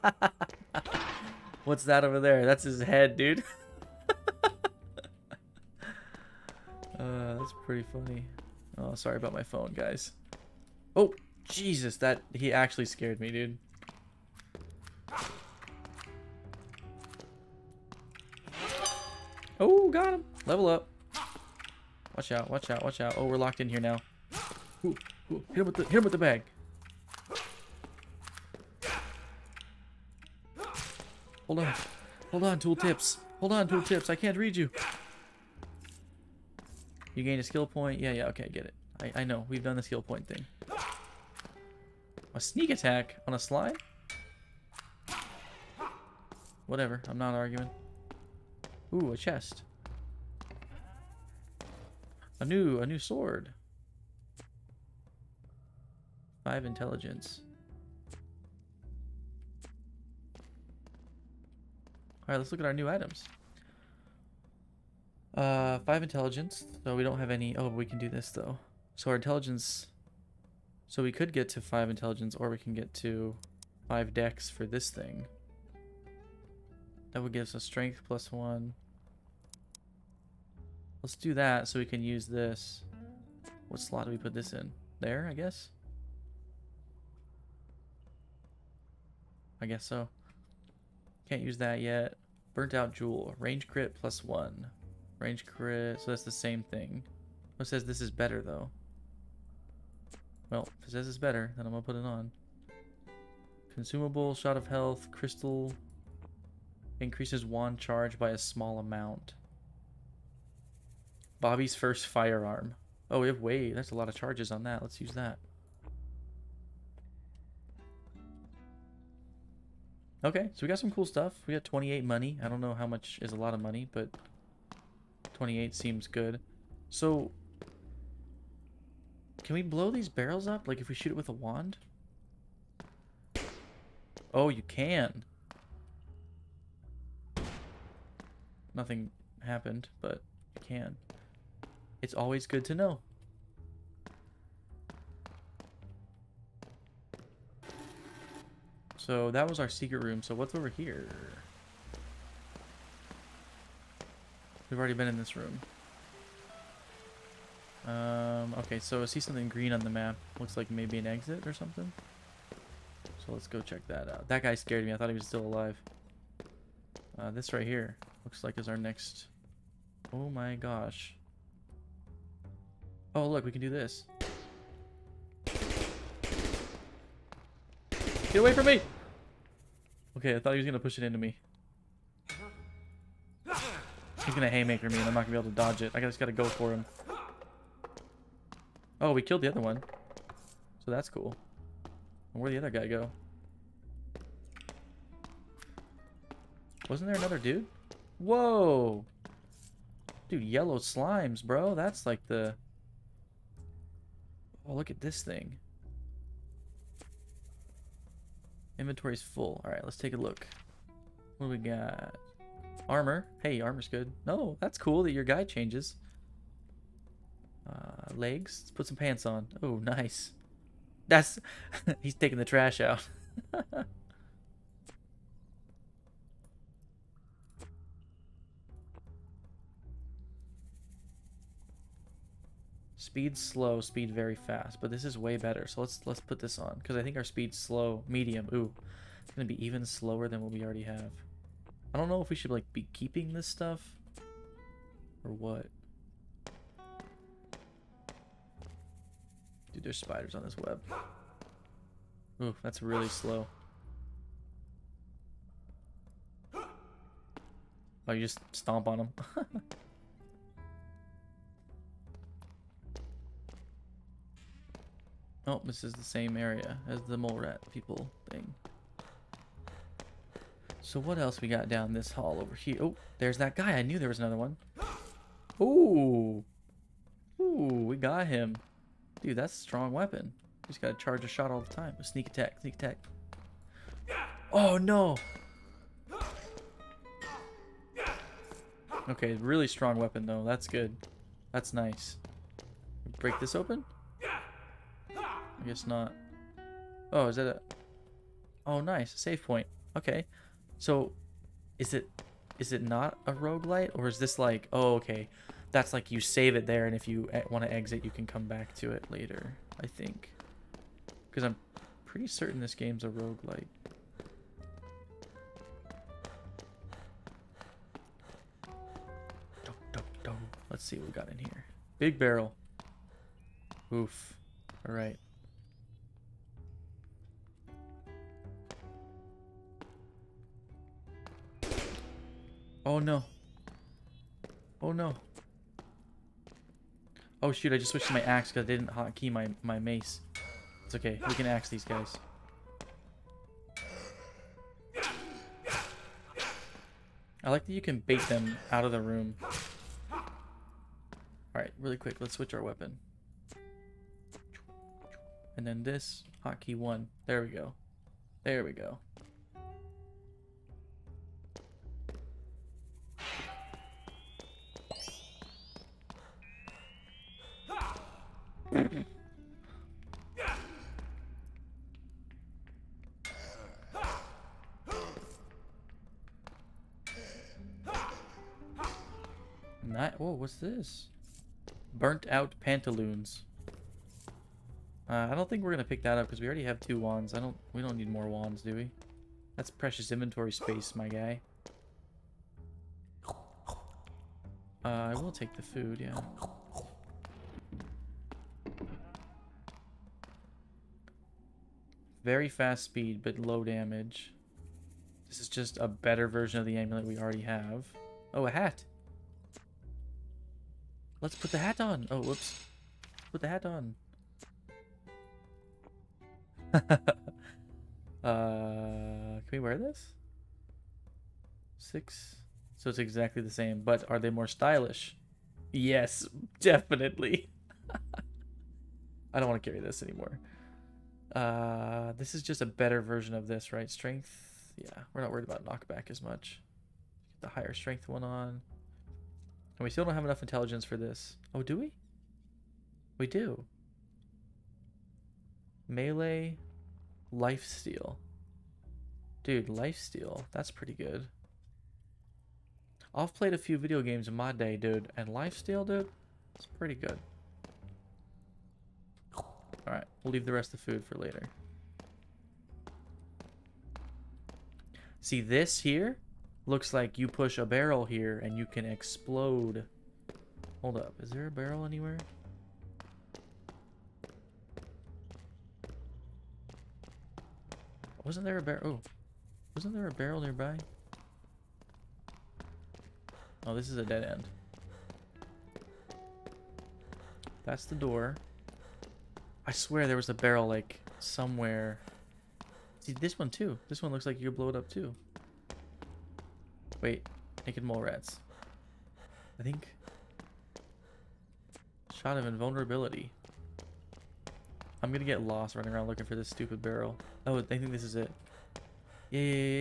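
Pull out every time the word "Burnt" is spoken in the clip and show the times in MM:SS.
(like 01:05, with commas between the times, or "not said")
01:32, 06:21.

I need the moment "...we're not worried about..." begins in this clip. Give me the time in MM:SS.
07:15.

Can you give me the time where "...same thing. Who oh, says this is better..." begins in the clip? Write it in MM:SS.
01:36.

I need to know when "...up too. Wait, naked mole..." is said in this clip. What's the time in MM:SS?
08:14.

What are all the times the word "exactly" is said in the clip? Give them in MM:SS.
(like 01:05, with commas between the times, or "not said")
07:02.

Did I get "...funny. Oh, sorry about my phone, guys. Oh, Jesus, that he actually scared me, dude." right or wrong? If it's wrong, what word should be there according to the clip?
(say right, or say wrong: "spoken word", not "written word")
right.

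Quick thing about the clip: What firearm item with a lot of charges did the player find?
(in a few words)
Bobby's first firearm.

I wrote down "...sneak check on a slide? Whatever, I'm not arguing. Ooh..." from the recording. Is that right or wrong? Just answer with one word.
wrong.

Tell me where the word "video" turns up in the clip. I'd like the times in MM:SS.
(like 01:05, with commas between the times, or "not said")
07:33.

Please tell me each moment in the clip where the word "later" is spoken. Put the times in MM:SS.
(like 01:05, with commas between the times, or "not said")
05:09, 07:41.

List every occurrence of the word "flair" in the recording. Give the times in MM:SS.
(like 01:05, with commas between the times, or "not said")
not said.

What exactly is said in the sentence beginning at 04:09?
Dude, there's spiders on this web.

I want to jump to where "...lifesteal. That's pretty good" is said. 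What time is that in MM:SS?
07:29.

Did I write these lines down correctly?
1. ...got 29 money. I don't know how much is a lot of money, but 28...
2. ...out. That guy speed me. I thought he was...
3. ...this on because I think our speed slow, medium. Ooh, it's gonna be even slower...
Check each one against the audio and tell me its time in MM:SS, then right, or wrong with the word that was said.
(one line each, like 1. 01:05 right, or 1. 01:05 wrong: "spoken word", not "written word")
1. 02:01 wrong: "28", not "29"
2. 02:44 wrong: "scared", not "speed"
3. 03:56 right.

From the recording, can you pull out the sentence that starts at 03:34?
No, that's cool that your guy changes.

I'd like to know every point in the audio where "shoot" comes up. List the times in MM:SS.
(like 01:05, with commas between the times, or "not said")
02:10, 05:37.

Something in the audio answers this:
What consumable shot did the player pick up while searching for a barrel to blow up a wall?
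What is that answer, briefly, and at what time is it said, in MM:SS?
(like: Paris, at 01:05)
Shot of invulnerability, at 08:22.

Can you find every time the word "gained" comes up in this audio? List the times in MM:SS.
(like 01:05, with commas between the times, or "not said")
00:37.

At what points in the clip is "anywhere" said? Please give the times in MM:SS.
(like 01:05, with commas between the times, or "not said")
07:51.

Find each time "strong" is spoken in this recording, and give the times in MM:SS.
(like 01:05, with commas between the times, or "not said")
04:39, 04:49.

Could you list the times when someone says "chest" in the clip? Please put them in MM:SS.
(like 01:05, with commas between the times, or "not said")
00:49.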